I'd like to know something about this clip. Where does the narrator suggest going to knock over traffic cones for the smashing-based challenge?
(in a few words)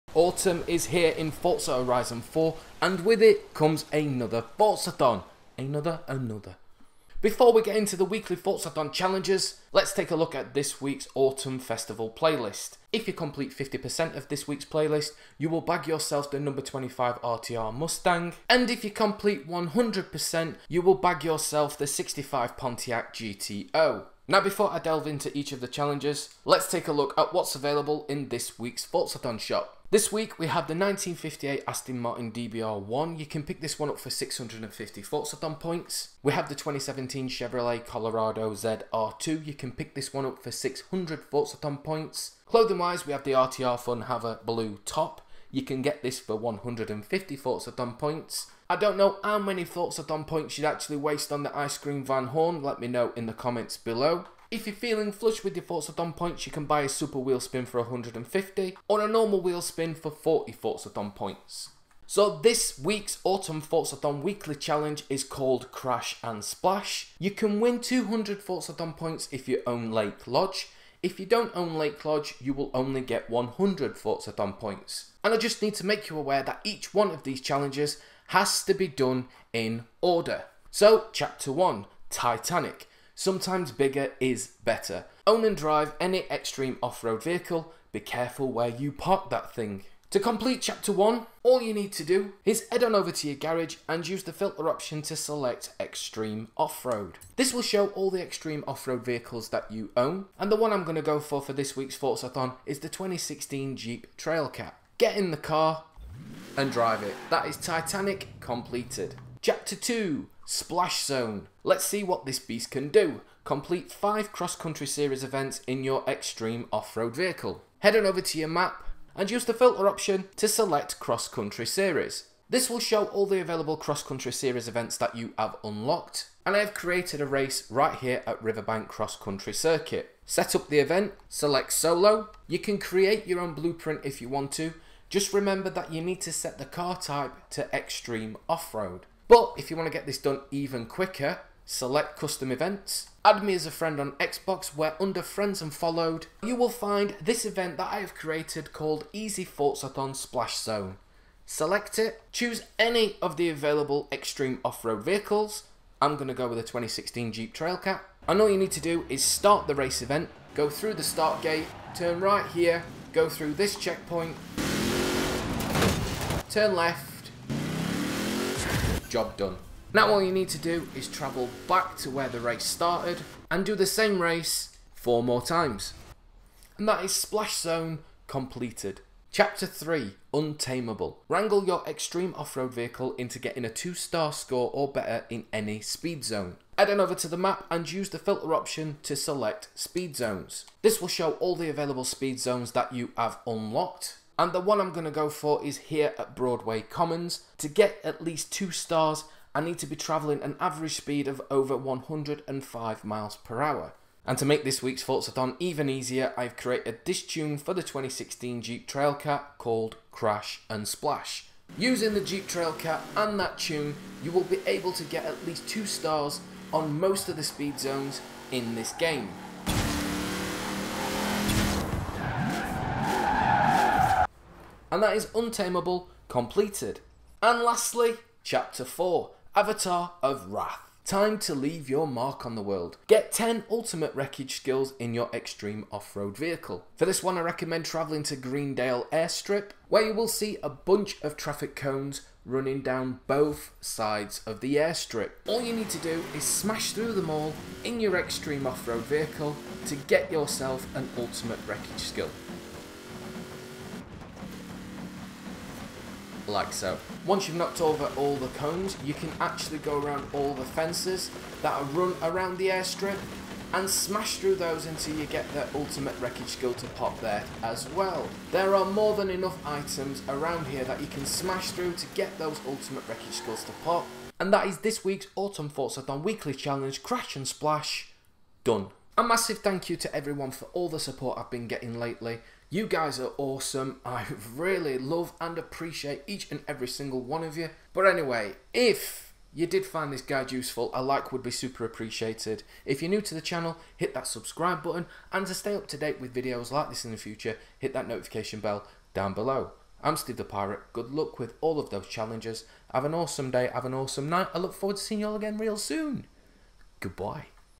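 Greendale Airstrip.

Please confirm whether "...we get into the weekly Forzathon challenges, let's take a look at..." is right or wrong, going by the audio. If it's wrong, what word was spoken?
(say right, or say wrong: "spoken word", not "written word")
right.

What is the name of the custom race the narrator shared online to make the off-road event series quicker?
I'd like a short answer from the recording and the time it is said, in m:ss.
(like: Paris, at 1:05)
Easy Forzathon Splash Zone, at 2:29.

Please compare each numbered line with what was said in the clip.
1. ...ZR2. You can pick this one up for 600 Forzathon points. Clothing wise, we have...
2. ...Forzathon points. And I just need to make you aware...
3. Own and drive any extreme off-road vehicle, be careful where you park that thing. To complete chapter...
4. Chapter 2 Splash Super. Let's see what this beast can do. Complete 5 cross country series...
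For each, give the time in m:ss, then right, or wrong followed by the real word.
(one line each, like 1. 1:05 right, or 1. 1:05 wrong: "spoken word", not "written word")
1. 0:38 right
2. 1:13 right
3. 1:25 right
4. 1:49 wrong: "Zone", not "Super".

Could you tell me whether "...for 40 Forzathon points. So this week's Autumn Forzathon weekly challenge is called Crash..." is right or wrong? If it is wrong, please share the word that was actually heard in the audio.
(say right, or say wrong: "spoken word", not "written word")
right.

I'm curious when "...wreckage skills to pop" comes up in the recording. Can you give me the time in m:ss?
4:33.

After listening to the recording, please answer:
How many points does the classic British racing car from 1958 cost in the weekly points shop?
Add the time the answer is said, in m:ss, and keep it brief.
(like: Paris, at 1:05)
650, at 0:34.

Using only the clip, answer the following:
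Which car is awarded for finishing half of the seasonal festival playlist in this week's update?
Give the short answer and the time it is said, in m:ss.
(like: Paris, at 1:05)
25 RTR Mustang, at 0:16.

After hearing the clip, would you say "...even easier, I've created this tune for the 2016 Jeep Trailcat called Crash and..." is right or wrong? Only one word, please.
right.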